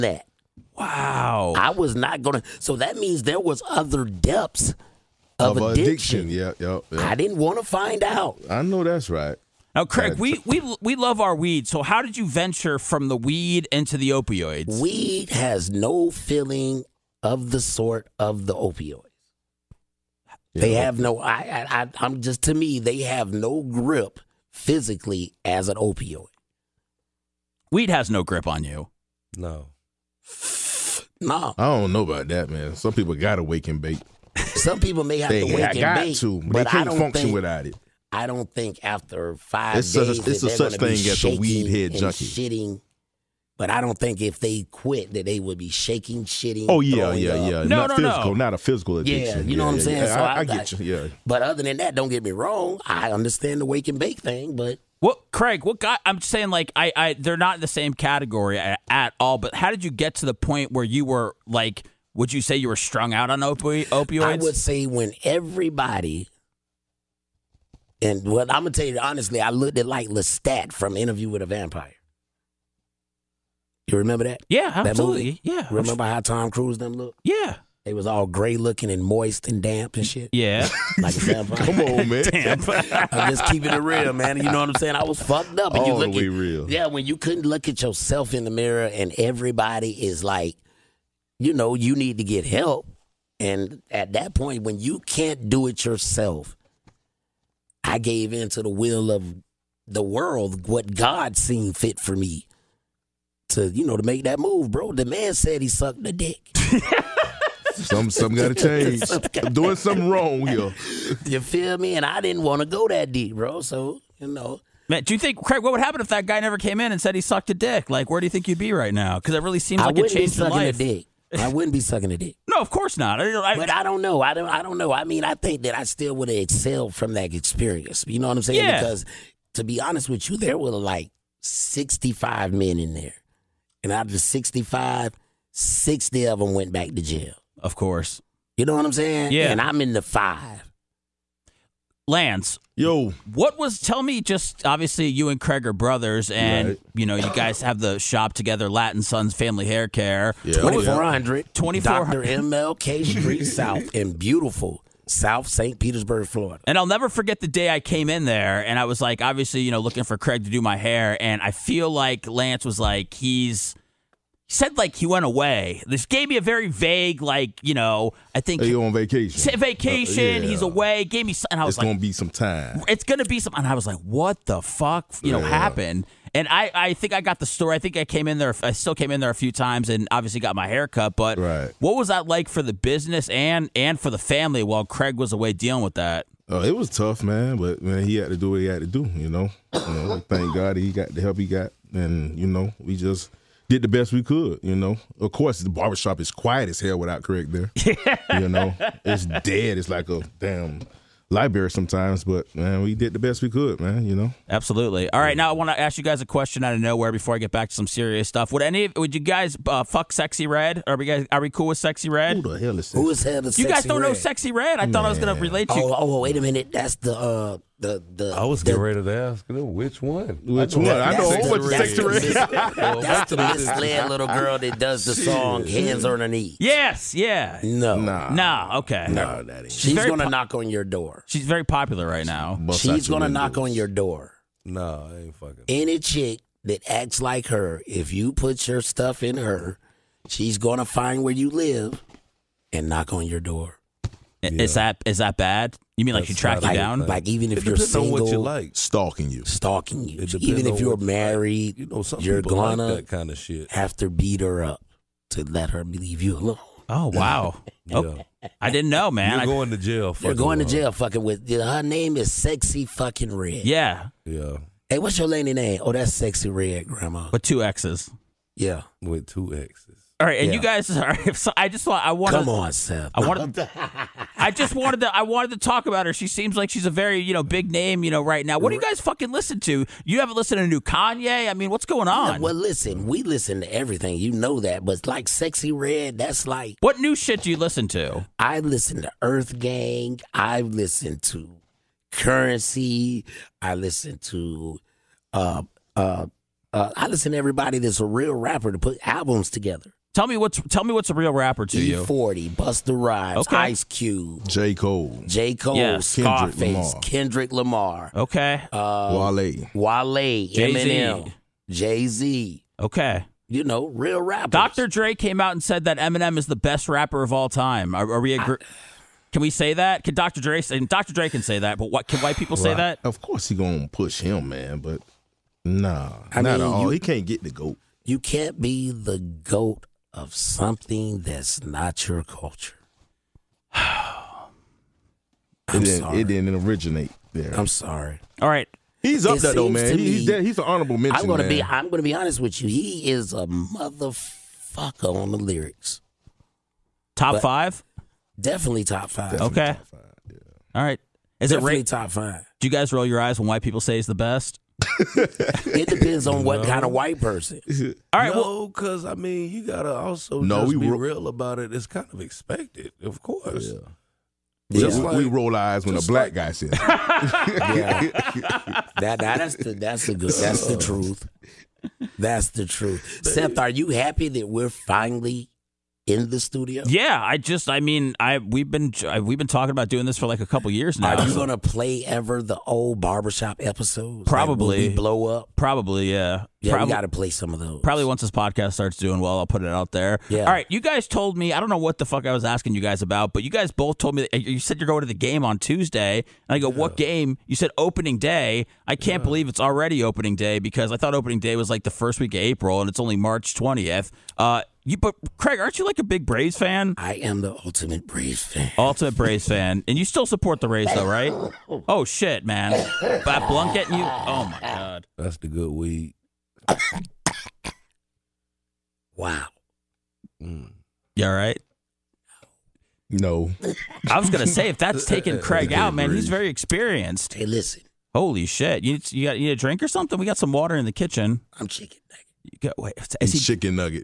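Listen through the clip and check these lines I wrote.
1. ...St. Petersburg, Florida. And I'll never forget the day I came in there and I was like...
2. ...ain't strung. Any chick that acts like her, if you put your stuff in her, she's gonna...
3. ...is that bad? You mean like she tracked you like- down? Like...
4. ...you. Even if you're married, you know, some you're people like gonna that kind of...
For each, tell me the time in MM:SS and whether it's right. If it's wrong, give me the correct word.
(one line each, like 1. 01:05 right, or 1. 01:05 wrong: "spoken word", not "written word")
1. 02:35 right
2. 03:55 wrong: "fucking", not "strung"
3. 04:05 right
4. 04:10 right.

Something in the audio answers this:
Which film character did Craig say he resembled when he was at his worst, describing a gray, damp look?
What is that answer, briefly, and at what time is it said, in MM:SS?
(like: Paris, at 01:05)
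Lestat, at 01:10.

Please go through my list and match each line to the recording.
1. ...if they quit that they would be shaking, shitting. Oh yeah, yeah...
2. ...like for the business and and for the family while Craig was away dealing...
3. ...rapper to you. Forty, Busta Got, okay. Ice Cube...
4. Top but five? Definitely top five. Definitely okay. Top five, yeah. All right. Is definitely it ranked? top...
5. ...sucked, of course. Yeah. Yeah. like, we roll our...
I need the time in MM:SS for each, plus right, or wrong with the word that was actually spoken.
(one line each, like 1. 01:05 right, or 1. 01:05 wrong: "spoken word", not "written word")
1. 00:44 right
2. 03:02 right
3. 05:01 wrong: "Rhymes", not "Got"
4. 05:47 right
5. 06:02 wrong: "expected", not "sucked".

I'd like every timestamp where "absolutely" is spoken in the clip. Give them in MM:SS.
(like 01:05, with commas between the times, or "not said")
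01:14, 03:24.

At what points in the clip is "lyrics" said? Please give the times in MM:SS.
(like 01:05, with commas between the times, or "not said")
05:45.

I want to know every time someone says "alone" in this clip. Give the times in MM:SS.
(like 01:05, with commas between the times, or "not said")
04:16.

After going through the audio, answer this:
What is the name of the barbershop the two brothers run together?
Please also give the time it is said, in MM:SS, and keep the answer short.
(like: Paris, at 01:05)
Latin Sons Family Hair Care, at 02:28.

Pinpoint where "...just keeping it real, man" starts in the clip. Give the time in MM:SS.
01:23.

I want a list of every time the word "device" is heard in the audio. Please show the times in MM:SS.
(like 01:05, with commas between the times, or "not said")
not said.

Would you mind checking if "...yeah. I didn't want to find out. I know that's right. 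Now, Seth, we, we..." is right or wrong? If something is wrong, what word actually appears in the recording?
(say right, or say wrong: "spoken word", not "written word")
wrong: "Craig", not "Seth".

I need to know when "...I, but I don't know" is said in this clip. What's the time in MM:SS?
02:03.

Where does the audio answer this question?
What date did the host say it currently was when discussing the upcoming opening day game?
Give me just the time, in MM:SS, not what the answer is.
06:43.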